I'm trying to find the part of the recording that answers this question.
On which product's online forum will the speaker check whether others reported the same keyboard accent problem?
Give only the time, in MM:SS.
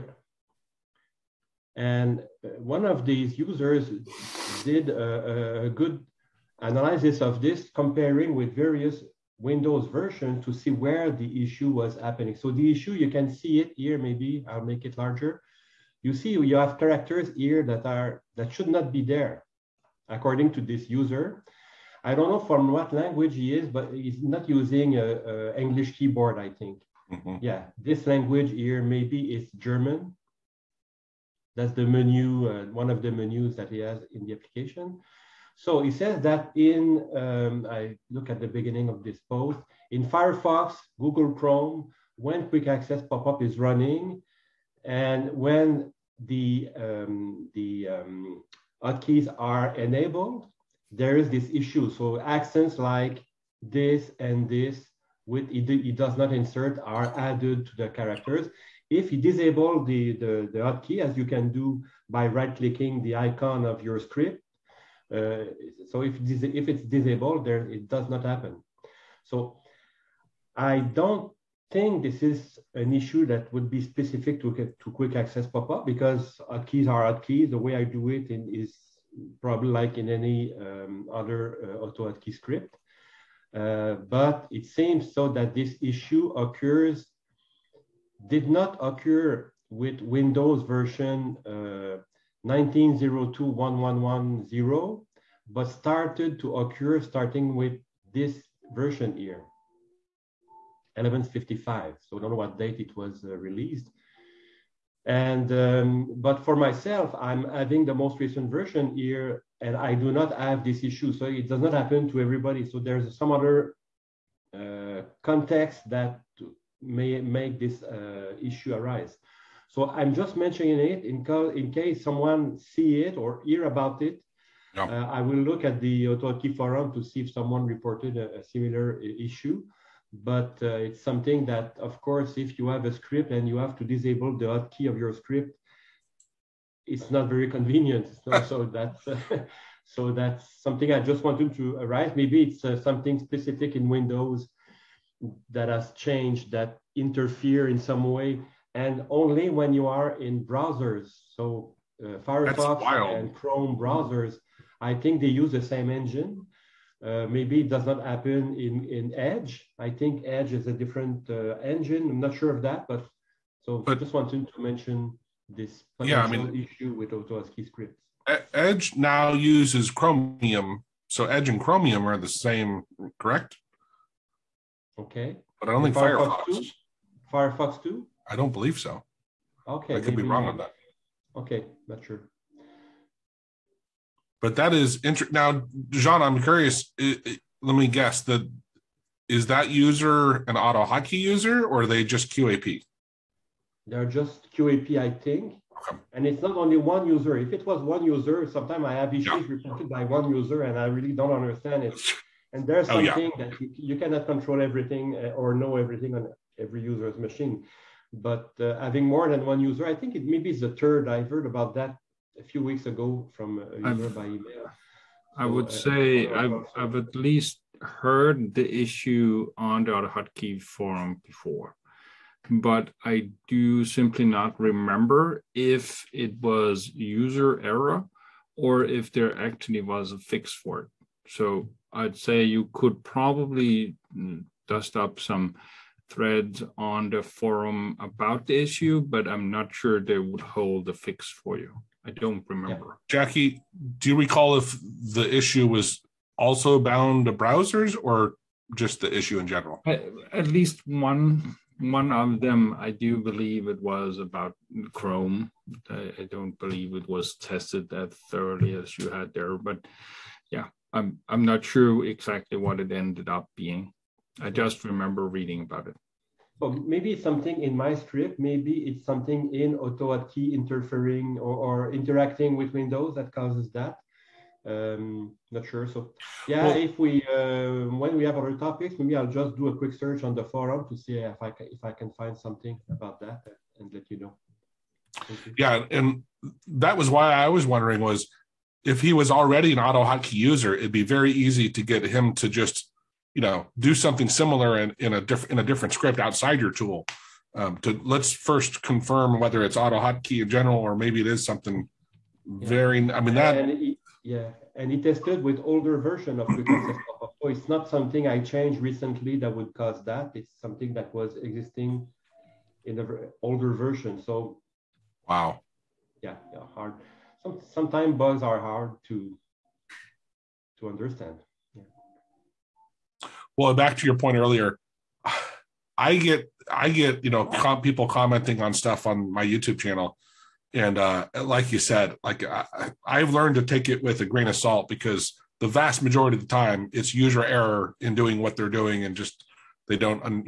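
02:06.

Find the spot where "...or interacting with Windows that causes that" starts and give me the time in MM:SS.
04:31.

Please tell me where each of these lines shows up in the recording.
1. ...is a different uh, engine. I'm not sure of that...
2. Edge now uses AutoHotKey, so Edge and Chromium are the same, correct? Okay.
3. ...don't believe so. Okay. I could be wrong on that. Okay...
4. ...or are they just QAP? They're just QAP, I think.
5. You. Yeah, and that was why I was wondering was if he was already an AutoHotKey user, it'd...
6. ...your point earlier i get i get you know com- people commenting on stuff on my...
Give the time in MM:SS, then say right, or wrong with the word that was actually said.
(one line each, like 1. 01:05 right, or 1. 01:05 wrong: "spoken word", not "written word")
1. 02:40 right
2. 02:48 wrong: "Chromium", not "AutoHotKey"
3. 02:58 right
4. 03:11 right
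5. 04:45 right
6. 05:24 right.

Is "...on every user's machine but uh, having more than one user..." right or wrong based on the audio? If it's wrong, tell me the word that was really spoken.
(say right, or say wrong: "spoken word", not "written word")
right.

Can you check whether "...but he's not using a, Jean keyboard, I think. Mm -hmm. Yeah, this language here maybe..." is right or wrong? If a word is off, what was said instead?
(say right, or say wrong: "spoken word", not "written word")
wrong: "English", not "Jean".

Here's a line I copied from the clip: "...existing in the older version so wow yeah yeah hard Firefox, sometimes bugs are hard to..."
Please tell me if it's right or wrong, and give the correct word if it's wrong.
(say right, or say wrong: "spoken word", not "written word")
wrong: "Some", not "Firefox".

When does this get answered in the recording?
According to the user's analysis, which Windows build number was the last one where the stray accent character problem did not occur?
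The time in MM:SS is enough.
01:32.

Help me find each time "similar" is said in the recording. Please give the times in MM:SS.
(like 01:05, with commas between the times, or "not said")
02:08, 04:54.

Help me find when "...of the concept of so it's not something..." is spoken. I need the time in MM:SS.
05:06.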